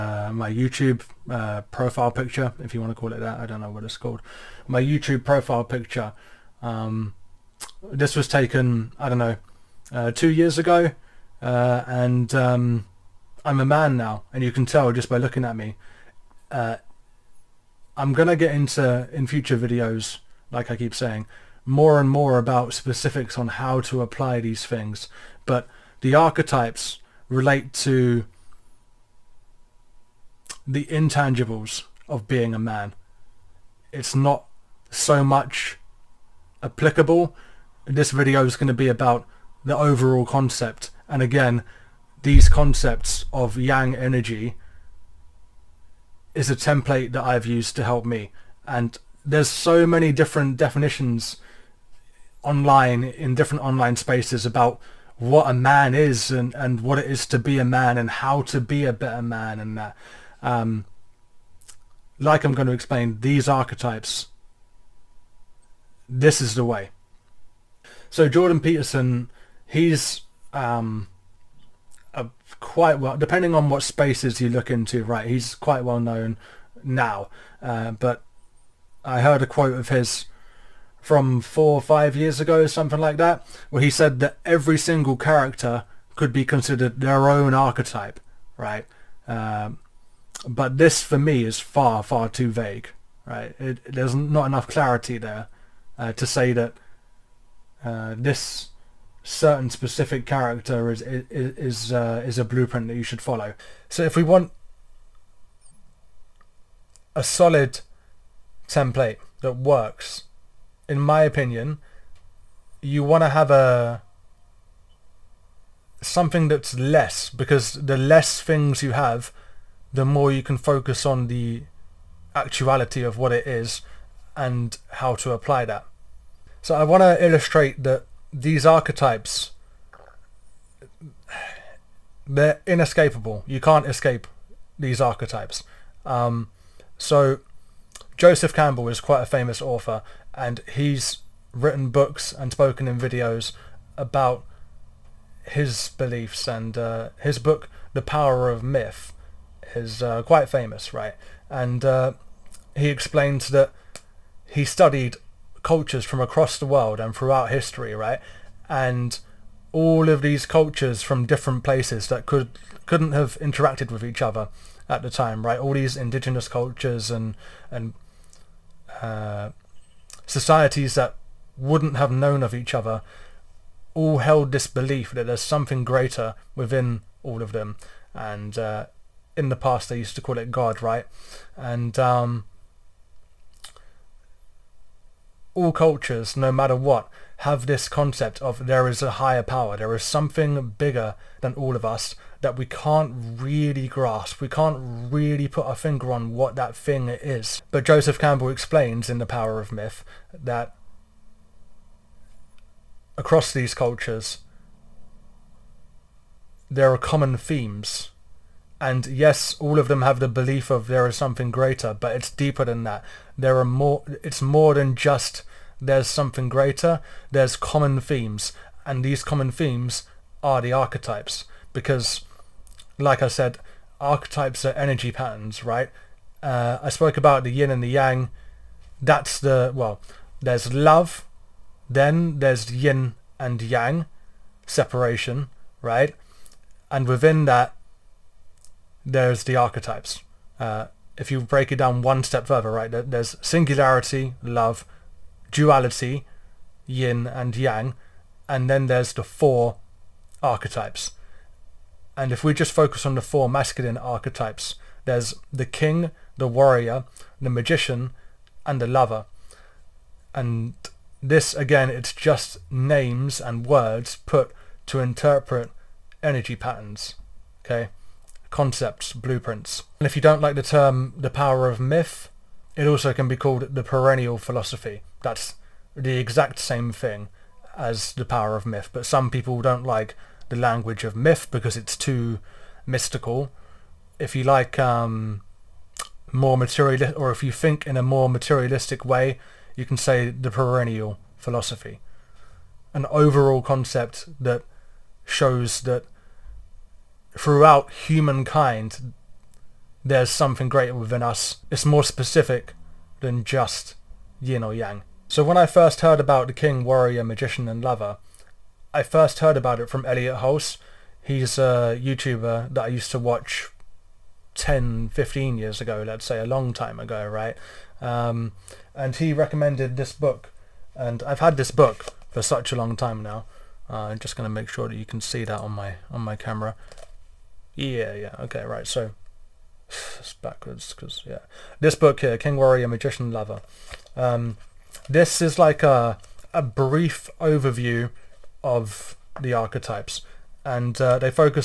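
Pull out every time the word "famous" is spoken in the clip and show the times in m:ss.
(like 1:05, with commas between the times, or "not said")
2:19, 2:30.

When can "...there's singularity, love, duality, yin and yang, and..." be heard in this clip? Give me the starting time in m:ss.
4:02.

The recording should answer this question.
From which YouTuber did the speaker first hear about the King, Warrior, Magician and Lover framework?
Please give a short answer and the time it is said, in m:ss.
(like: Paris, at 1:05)
Elliot Hulse, at 5:10.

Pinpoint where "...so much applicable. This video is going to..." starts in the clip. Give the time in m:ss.
0:34.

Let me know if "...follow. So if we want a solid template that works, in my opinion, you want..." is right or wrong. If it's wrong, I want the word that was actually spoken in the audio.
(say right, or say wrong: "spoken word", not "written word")
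right.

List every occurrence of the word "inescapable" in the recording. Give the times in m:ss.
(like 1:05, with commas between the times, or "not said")
2:12.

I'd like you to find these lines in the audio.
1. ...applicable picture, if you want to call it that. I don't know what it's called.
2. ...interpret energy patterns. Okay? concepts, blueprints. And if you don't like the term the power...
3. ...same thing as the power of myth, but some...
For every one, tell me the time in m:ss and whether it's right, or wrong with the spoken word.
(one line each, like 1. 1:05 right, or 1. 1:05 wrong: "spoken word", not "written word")
1. 0:01 wrong: "profile", not "applicable"
2. 4:24 right
3. 4:36 right.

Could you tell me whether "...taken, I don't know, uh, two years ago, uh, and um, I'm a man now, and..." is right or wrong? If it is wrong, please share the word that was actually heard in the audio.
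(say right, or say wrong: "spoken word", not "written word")
right.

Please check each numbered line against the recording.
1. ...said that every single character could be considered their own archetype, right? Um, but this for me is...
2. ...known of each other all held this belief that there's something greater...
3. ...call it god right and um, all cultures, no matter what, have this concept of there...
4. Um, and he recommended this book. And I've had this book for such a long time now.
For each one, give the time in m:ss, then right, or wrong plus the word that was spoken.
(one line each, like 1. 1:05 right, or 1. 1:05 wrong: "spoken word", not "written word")
1. 1:23 right
2. 2:52 right
3. 3:00 right
4. 5:17 right.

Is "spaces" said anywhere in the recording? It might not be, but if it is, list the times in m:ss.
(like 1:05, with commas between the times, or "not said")
0:53, 1:13.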